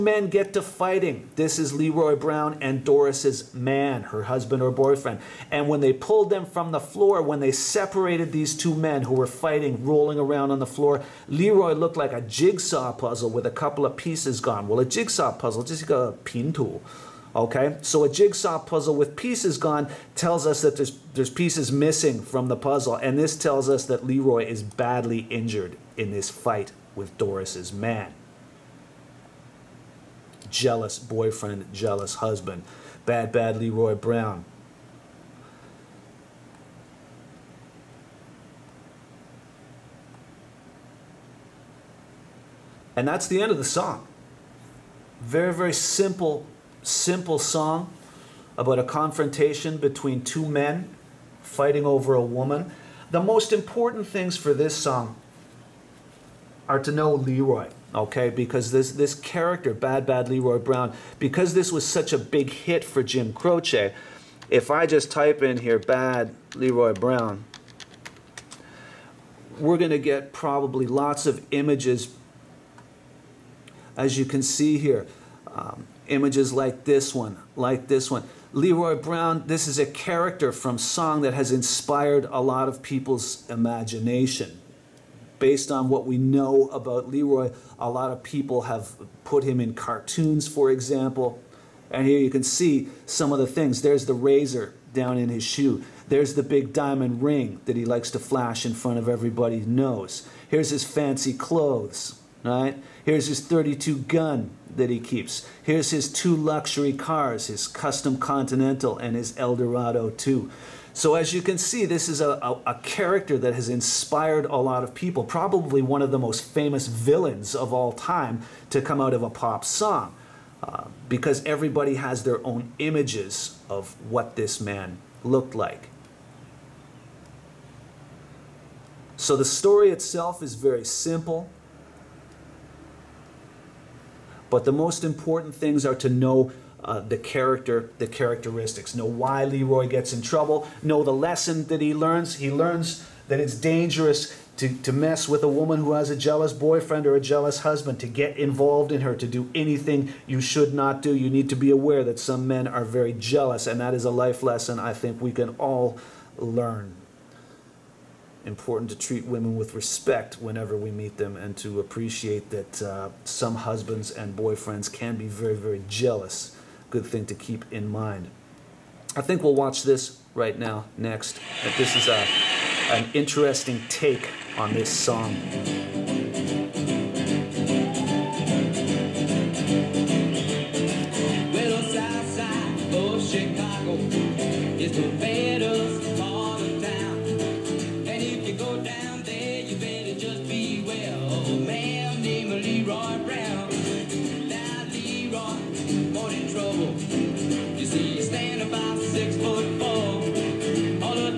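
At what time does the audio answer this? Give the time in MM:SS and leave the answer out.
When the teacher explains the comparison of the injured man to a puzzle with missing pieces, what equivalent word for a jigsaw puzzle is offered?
00:16.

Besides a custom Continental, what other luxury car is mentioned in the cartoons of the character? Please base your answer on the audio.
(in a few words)
Eldorado.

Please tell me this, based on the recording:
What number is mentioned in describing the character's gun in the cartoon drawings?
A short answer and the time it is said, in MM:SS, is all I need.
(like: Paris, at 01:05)
32, at 01:43.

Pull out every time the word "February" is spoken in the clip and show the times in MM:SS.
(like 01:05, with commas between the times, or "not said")
not said.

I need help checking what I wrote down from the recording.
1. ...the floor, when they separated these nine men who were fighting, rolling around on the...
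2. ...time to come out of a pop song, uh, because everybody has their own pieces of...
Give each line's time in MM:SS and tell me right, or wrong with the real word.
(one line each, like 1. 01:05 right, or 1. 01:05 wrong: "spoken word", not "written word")
1. 00:06 wrong: "two", not "nine"
2. 01:57 wrong: "images", not "pieces".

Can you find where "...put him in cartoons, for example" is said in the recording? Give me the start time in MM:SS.
01:29.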